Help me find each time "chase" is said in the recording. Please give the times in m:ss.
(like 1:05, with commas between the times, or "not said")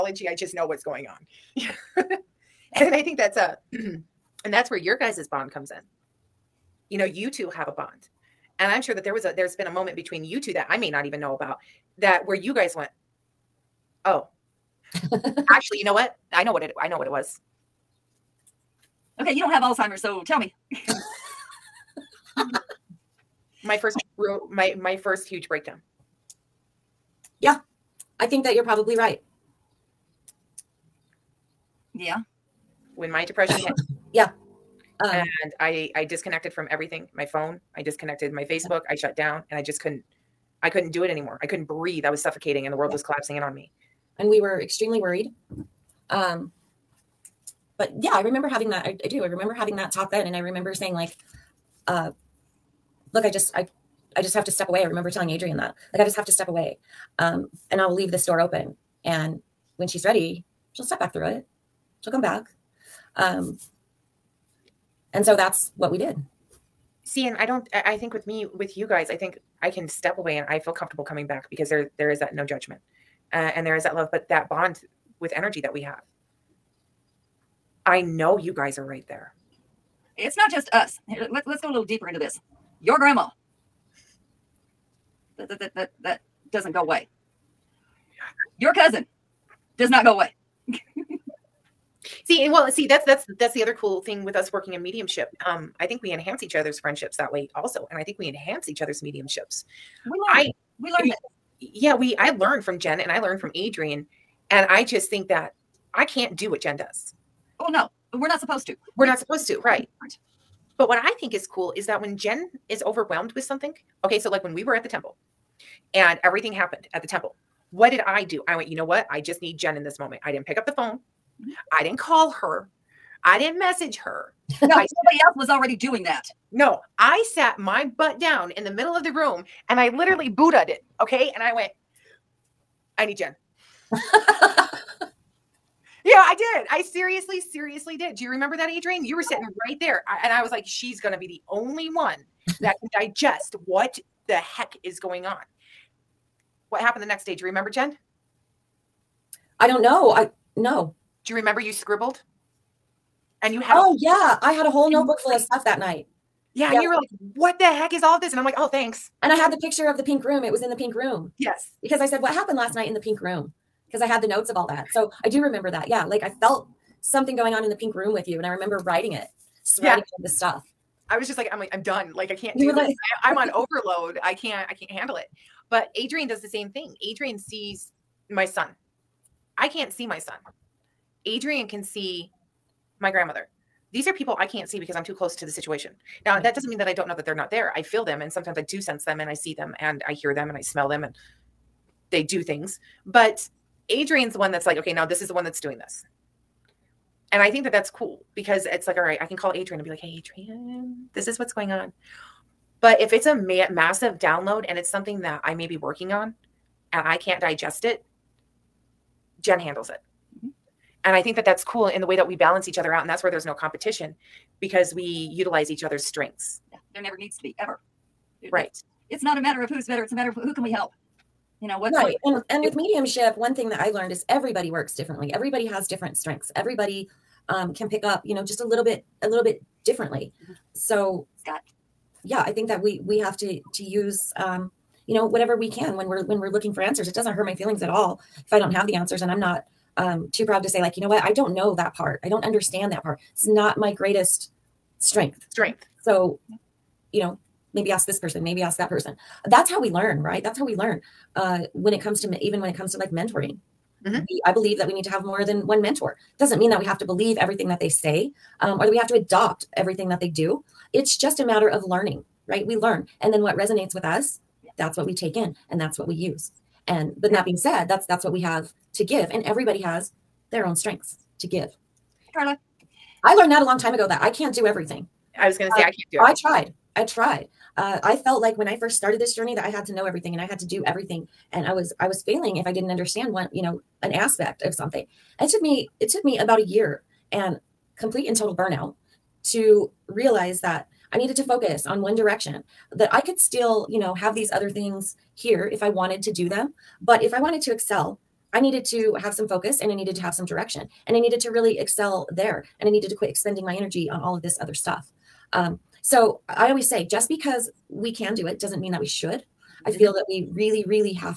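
not said.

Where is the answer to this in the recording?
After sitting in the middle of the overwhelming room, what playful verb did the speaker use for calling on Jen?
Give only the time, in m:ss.
2:10.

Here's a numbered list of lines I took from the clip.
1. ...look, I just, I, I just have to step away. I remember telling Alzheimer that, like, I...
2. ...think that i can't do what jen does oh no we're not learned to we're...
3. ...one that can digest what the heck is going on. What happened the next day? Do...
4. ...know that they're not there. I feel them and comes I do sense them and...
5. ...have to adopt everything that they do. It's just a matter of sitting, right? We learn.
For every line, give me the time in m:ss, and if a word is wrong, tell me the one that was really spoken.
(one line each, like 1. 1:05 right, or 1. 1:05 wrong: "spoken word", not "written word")
1. 0:53 wrong: "Adrienne", not "Alzheimer"
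2. 1:45 wrong: "supposed", not "learned"
3. 2:21 right
4. 3:07 wrong: "sometimes", not "comes"
5. 4:18 wrong: "learning", not "sitting".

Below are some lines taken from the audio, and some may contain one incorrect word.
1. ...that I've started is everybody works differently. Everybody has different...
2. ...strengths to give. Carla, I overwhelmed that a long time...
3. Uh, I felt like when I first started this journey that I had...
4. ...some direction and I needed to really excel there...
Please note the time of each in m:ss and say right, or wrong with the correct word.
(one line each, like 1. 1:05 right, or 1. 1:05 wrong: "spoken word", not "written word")
1. 3:43 wrong: "learned", not "started"
2. 4:30 wrong: "learned", not "overwhelmed"
3. 4:37 right
4. 5:00 right.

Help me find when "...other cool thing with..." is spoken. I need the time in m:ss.
1:33.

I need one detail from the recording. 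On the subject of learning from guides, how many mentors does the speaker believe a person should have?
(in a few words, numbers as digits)
more than one.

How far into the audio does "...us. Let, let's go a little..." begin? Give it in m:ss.
1:20.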